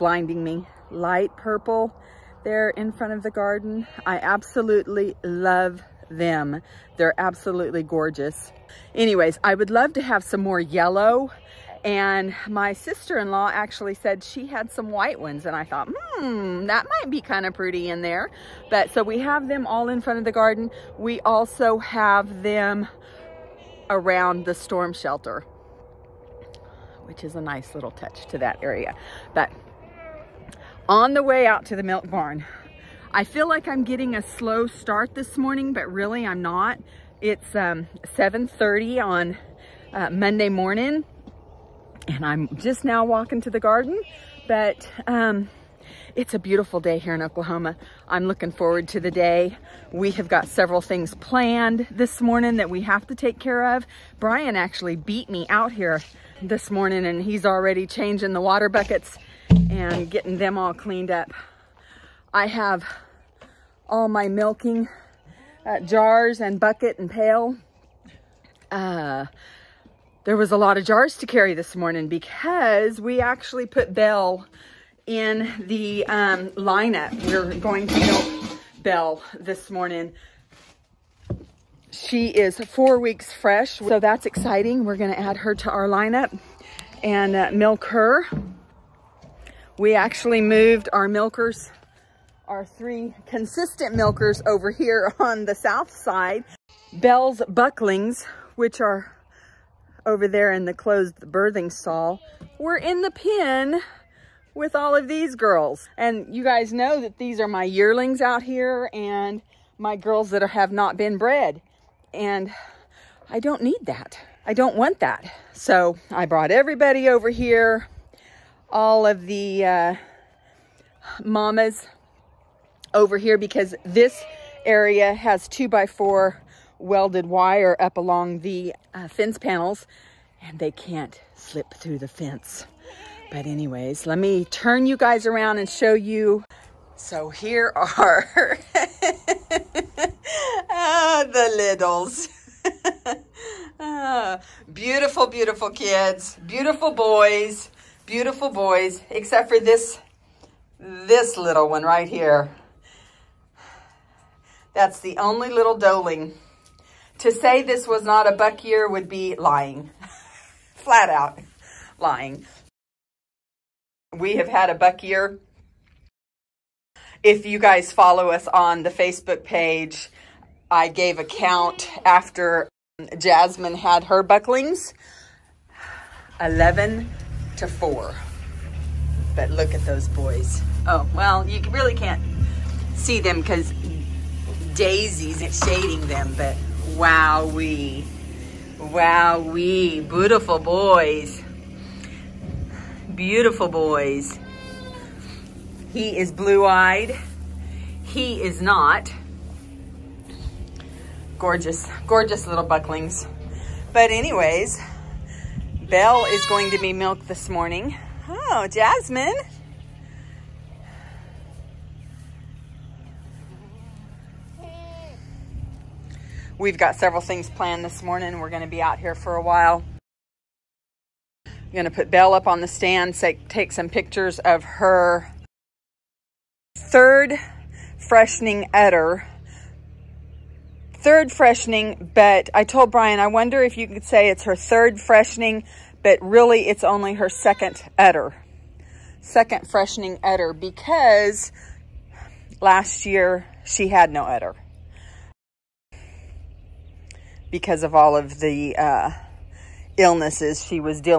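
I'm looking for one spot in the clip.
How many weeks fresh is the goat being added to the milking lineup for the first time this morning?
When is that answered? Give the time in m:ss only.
1:22.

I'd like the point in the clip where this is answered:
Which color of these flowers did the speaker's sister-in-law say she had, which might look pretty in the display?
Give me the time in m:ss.
0:14.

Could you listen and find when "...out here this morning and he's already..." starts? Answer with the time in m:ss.
0:55.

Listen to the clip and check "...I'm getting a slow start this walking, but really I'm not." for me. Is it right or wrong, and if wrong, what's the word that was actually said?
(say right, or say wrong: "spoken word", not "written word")
wrong: "morning", not "walking".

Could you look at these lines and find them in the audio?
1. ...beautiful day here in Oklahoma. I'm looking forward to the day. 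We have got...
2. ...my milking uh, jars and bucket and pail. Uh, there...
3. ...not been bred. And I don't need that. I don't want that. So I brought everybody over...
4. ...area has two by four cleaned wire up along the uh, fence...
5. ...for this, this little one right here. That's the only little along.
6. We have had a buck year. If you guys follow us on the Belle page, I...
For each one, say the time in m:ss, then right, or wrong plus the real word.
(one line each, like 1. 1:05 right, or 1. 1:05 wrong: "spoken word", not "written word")
1. 0:46 right
2. 1:04 right
3. 1:50 right
4. 2:04 wrong: "welded", not "cleaned"
5. 2:29 wrong: "doeling", not "along"
6. 2:44 wrong: "Facebook", not "Belle".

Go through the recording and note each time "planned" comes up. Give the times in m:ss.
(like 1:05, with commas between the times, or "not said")
0:51, 3:37.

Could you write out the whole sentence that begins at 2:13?
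But anyways, let me turn you guys around and show you.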